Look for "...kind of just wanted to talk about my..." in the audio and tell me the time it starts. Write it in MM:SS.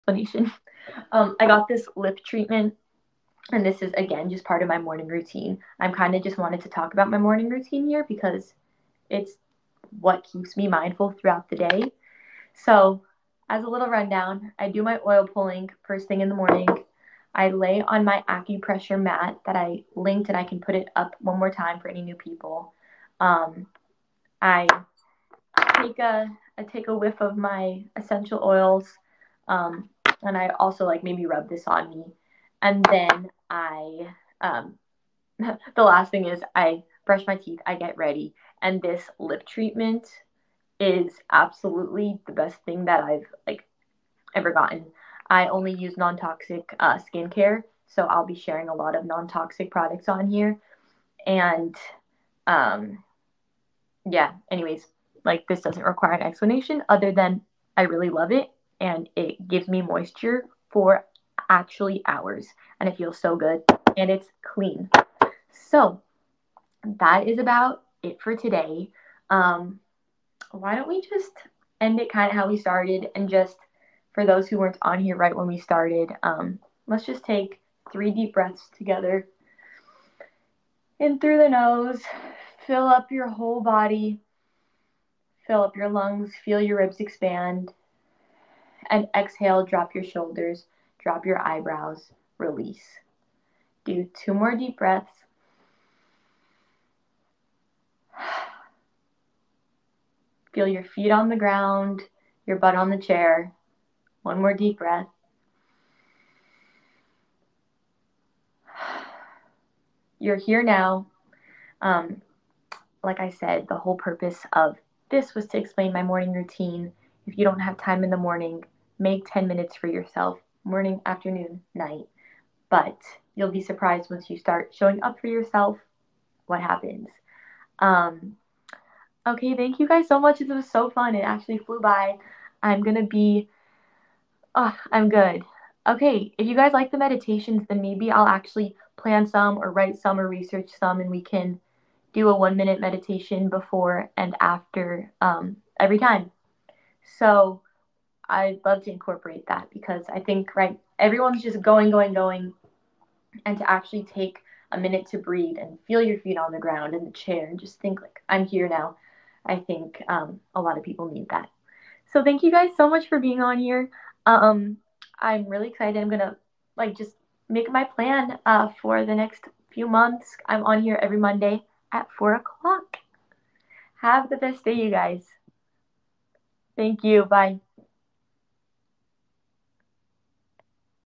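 00:05.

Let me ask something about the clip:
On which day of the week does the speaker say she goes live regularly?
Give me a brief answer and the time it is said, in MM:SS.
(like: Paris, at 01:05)
Monday, at 02:51.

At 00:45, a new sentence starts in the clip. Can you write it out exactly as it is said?
I only use non-toxic uh, skincare, so I'll be sharing a lot of non-toxic products on here, and um, yeah.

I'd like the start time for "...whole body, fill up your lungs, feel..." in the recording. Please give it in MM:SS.
01:23.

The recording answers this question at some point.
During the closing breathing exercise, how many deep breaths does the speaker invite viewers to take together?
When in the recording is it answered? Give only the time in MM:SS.
01:17.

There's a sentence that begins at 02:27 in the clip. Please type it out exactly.
So I'd love to incorporate that because I think, right, everyone's just going, going, going.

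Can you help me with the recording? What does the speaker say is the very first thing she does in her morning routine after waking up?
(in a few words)
oil pulling.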